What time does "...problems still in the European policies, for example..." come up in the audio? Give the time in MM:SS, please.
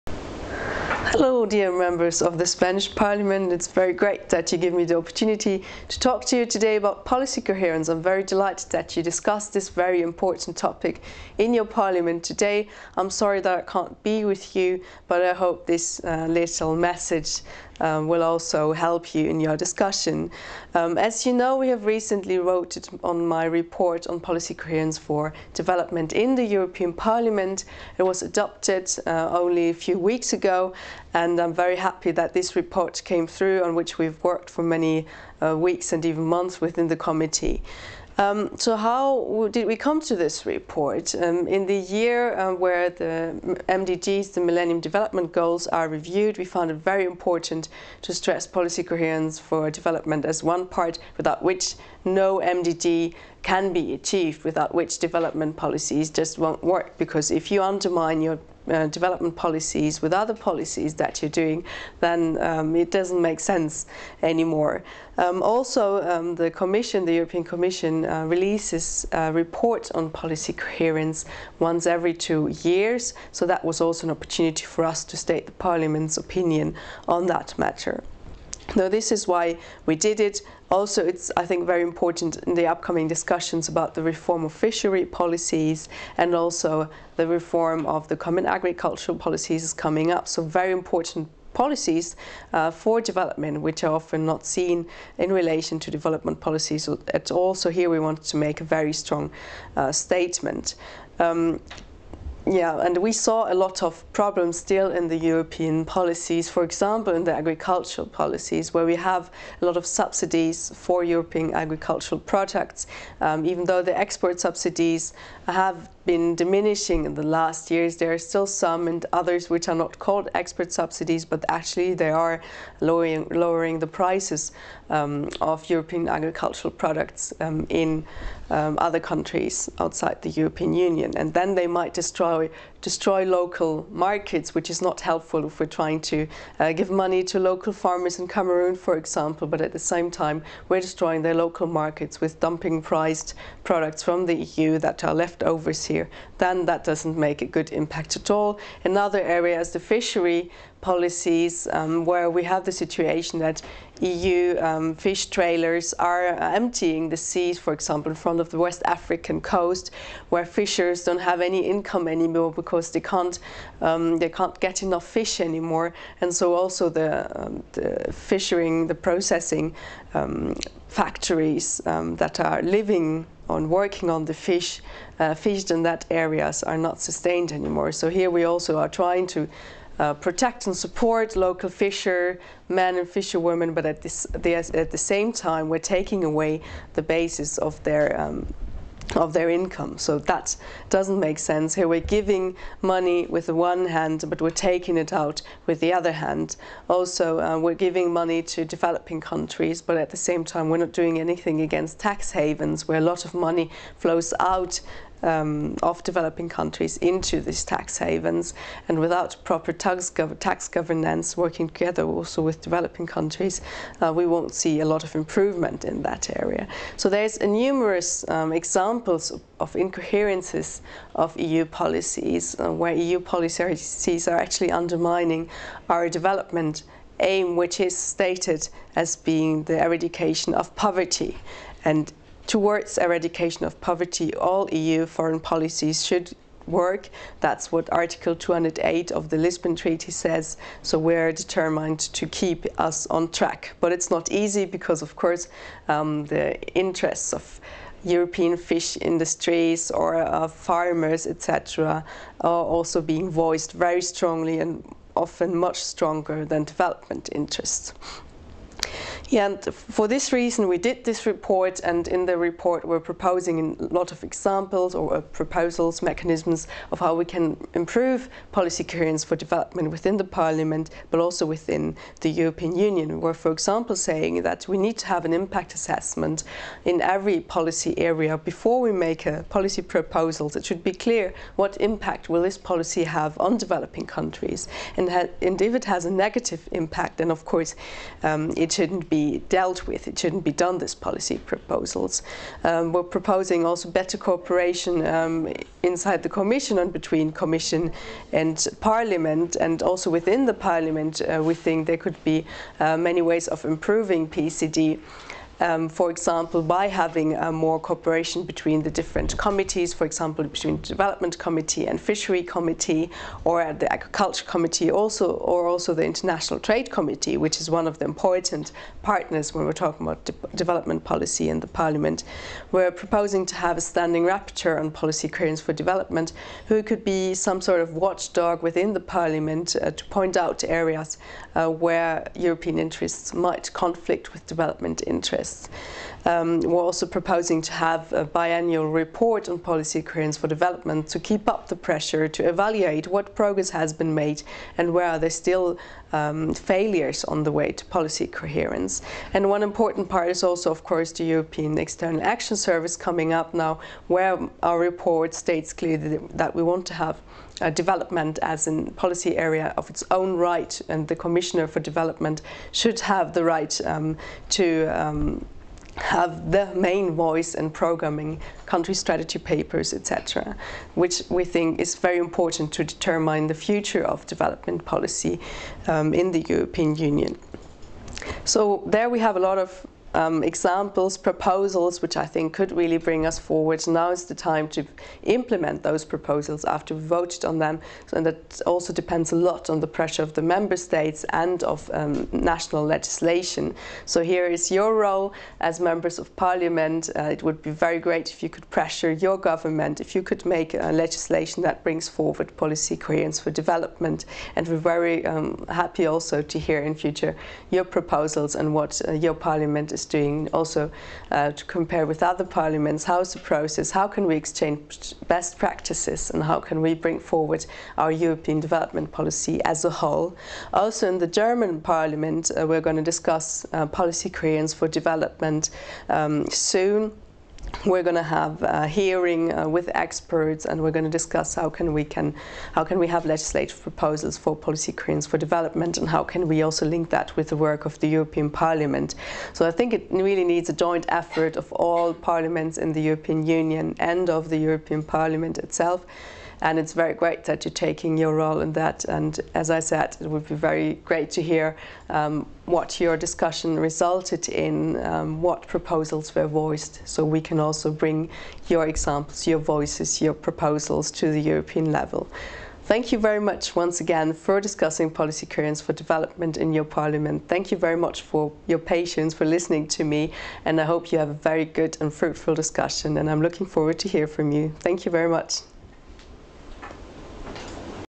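01:44.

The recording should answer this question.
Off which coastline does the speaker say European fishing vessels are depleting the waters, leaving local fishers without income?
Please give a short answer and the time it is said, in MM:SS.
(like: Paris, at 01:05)
West African coast, at 02:38.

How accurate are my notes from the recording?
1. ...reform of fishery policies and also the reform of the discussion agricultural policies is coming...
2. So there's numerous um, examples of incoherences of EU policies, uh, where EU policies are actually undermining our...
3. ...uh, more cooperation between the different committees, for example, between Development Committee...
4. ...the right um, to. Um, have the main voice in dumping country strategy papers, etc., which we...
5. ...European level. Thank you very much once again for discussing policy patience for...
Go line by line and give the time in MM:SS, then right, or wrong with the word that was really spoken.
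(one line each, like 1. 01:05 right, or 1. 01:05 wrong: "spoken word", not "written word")
1. 01:24 wrong: "common", not "discussion"
2. 03:36 right
3. 05:07 right
4. 06:03 wrong: "programming", not "dumping"
5. 07:41 wrong: "coherence", not "patience".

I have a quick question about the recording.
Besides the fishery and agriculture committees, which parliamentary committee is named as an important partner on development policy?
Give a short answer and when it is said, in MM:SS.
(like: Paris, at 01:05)
International Trade Committee, at 05:16.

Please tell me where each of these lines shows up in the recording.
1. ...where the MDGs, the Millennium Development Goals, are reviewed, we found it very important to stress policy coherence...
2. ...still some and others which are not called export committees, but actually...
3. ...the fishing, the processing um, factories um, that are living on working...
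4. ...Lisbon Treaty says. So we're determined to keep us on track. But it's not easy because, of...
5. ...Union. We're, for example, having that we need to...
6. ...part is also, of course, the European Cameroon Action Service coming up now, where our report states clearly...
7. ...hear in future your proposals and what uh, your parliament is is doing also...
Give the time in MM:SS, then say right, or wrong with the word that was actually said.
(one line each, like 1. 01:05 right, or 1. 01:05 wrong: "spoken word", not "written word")
1. 00:42 right
2. 01:58 wrong: "subsidies", not "committees"
3. 02:47 right
4. 03:59 right
5. 04:32 wrong: "saying", not "having"
6. 05:50 wrong: "External", not "Cameroon"
7. 06:46 right.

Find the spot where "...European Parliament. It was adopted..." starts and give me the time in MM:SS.
00:26.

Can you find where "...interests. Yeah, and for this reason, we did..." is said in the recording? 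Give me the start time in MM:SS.
04:17.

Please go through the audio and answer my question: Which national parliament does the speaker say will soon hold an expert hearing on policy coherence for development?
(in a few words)
German parliament.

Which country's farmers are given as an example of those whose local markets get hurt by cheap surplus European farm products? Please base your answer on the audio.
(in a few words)
Cameroon.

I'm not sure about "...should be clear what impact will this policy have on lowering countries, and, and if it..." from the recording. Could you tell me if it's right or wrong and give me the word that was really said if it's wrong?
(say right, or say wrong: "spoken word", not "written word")
wrong: "developing", not "lowering".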